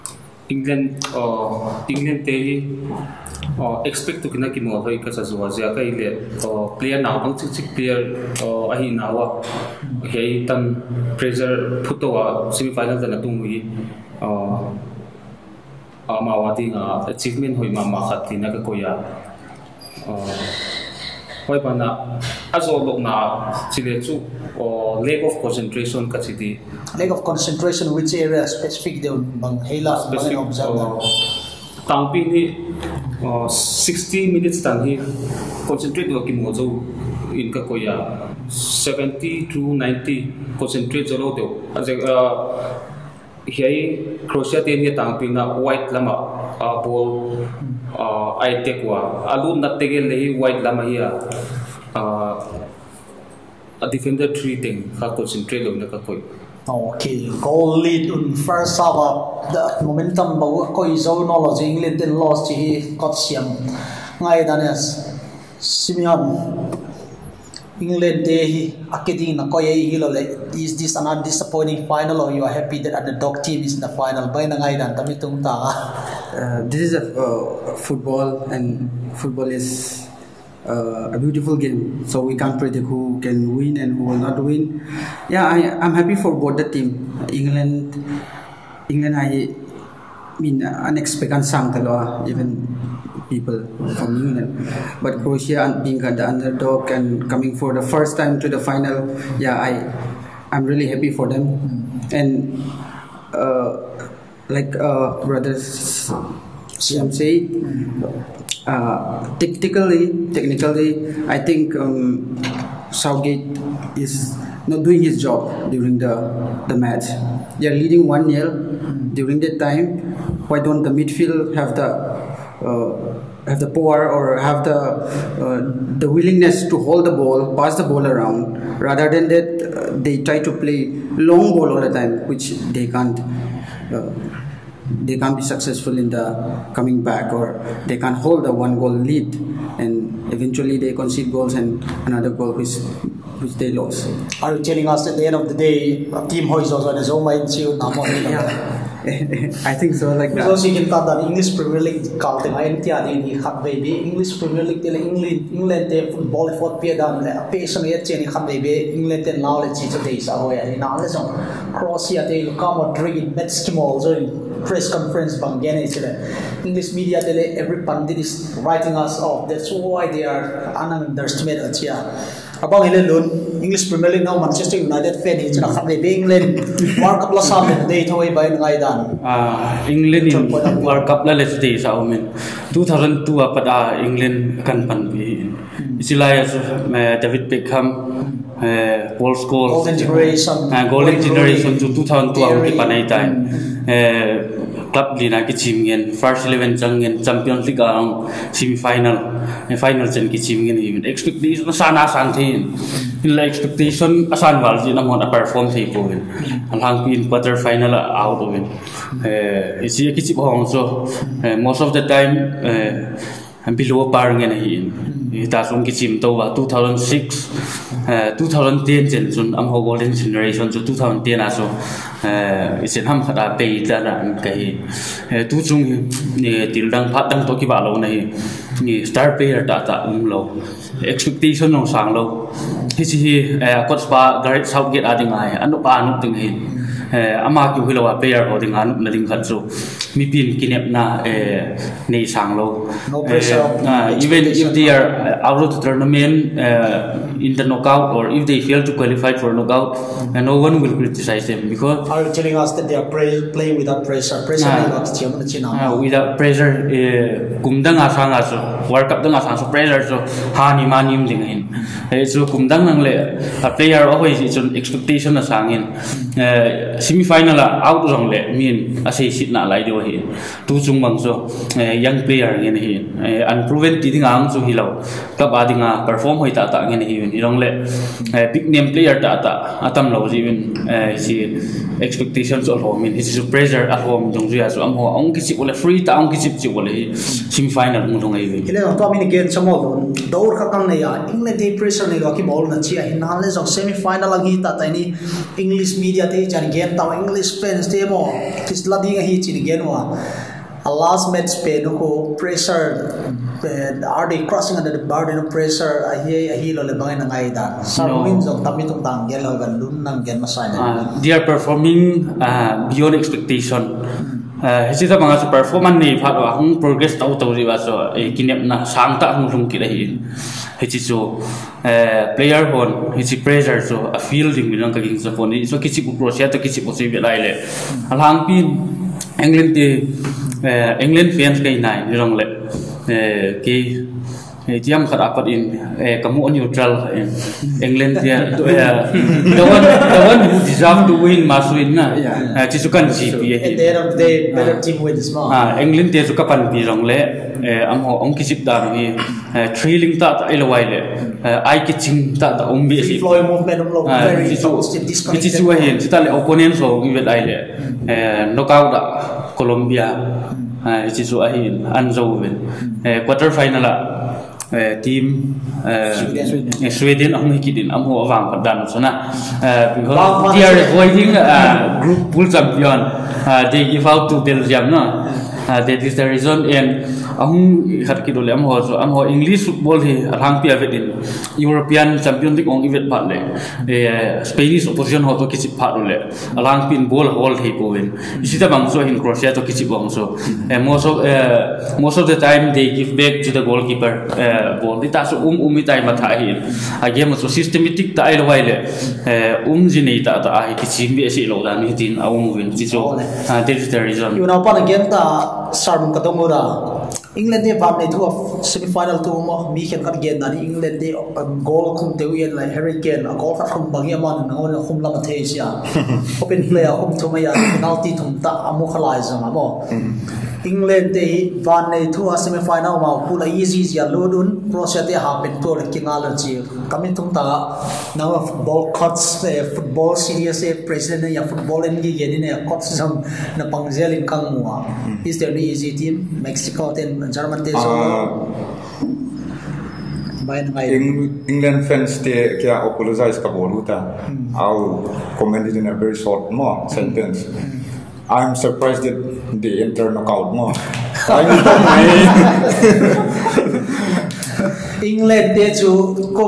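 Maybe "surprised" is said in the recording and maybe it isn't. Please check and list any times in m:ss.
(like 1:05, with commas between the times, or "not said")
7:28.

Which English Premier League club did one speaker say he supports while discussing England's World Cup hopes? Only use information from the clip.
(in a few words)
Manchester United.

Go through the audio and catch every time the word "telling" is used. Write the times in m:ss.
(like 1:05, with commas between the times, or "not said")
2:24, 4:12.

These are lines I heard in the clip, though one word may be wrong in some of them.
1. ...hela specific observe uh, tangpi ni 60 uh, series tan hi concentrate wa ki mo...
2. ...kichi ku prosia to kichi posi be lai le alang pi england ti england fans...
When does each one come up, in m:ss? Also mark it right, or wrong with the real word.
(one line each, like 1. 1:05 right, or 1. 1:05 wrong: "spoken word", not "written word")
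1. 0:29 wrong: "minutes", not "series"
2. 5:25 right.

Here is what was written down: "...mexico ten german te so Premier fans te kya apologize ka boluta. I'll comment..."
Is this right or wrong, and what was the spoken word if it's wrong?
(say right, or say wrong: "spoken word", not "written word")
wrong: "England", not "Premier".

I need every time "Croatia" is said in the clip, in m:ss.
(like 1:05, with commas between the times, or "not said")
0:44, 1:35, 2:41.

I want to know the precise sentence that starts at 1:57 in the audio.
They are leading 1 0 mm-hmm.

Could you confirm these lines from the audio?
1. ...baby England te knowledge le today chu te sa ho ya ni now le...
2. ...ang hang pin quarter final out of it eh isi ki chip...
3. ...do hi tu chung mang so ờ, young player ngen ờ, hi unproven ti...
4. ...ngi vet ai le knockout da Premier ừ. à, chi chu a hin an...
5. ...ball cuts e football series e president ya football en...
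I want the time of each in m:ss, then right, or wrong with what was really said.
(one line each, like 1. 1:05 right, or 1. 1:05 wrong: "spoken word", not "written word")
1. 2:38 right
2. 3:26 right
3. 4:29 right
4. 5:57 wrong: "Colombia", not "Premier"
5. 7:08 right.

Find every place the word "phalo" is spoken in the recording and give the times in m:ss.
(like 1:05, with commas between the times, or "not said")
5:16.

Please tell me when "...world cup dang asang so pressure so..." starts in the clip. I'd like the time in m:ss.
4:18.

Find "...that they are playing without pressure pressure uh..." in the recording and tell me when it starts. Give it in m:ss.
4:12.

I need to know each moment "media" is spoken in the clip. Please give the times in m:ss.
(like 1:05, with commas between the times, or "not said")
2:46, 4:56.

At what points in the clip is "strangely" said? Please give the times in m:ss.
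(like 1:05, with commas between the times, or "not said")
not said.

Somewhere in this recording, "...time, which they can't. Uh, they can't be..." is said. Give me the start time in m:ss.
2:11.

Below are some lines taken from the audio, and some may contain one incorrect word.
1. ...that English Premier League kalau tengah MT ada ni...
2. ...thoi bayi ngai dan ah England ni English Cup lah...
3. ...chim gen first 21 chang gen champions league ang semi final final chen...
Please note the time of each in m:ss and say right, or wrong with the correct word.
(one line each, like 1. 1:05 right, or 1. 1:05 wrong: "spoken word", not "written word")
1. 2:31 right
2. 2:58 wrong: "World", not "English"
3. 3:15 wrong: "11", not "21".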